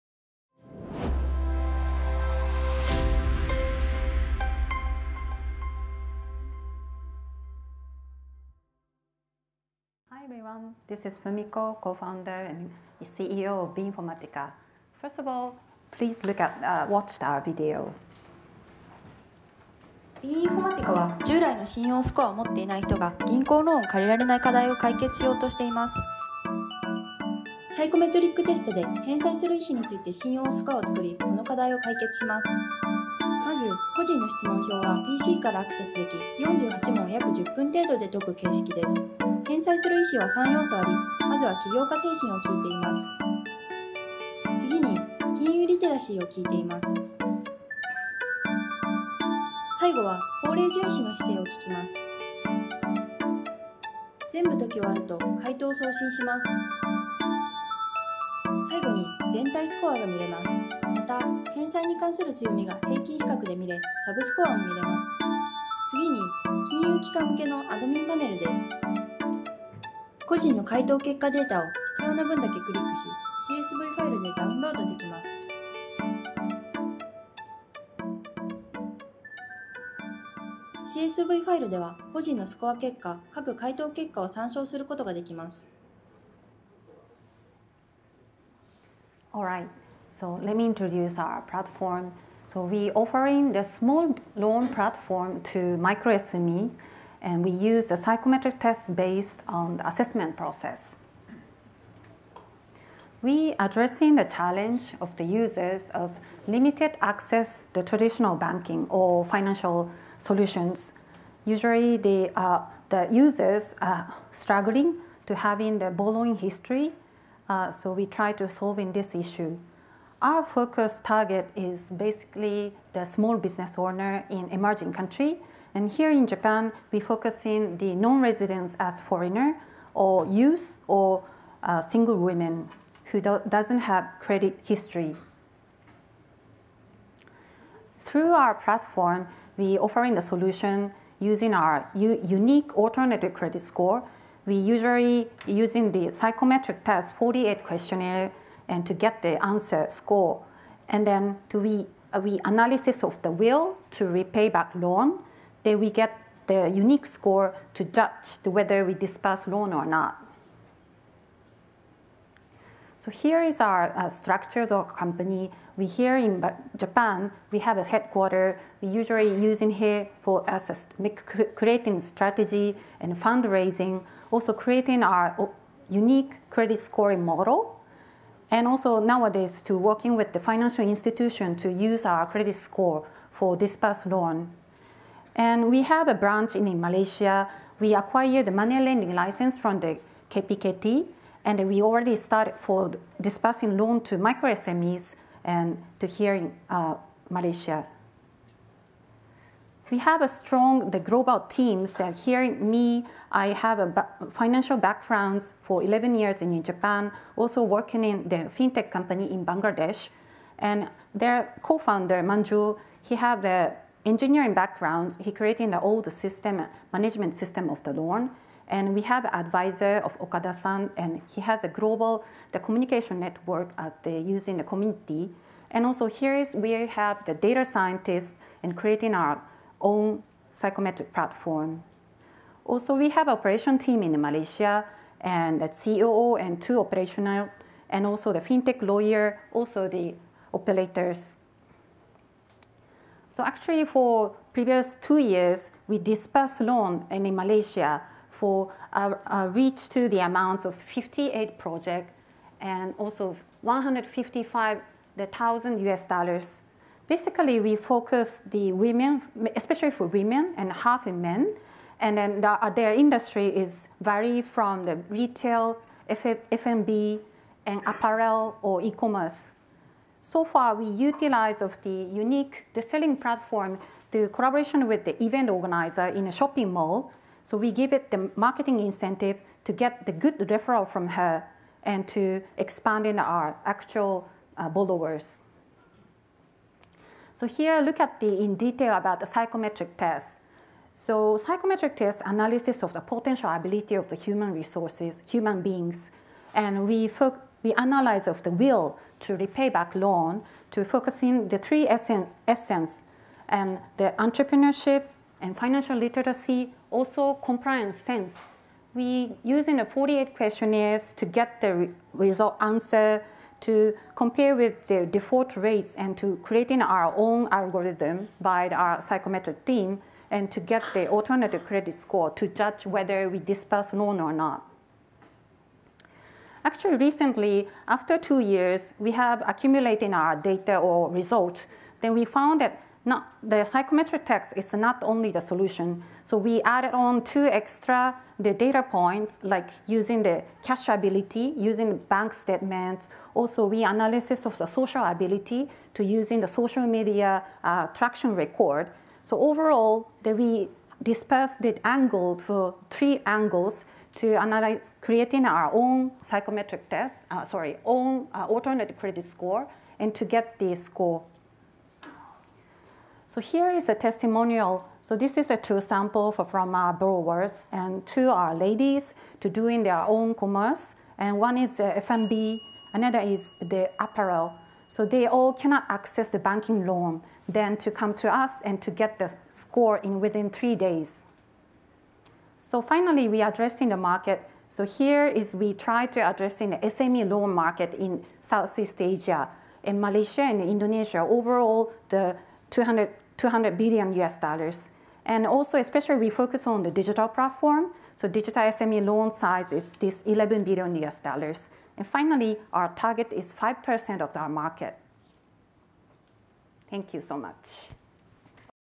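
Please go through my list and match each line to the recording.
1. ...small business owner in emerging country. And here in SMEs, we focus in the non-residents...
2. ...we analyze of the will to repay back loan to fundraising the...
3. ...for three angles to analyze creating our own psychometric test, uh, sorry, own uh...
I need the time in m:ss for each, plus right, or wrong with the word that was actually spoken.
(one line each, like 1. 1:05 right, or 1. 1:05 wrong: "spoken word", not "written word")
1. 2:03 wrong: "Japan", not "SMEs"
2. 4:57 wrong: "focusing", not "fundraising"
3. 5:52 right.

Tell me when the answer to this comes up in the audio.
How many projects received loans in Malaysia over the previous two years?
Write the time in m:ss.
4:10.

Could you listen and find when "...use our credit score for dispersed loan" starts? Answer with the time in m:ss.
3:01.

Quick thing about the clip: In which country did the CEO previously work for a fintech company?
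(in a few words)
Bangladesh.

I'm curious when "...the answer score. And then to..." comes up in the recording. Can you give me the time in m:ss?
2:29.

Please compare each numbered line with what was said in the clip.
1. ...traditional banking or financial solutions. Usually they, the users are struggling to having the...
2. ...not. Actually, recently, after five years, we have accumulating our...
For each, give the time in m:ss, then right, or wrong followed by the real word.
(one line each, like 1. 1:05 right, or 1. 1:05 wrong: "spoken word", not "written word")
1. 1:47 right
2. 5:24 wrong: "two", not "five".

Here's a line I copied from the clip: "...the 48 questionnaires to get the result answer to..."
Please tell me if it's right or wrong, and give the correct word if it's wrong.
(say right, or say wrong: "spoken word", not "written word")
right.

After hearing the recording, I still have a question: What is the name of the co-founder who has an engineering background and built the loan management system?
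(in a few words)
Manju.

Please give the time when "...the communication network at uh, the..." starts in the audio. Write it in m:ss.
3:42.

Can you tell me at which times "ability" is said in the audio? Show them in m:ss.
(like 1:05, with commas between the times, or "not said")
4:53, 5:40, 5:45.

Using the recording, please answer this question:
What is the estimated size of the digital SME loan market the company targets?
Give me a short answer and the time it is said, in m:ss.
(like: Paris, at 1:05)
11 billion US dollars, at 6:40.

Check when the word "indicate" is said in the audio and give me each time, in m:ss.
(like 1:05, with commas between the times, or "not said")
not said.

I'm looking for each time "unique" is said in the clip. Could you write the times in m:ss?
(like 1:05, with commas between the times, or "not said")
2:21, 2:36, 2:55, 4:32.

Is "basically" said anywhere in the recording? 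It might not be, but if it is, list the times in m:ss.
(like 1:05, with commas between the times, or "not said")
2:01, 4:17.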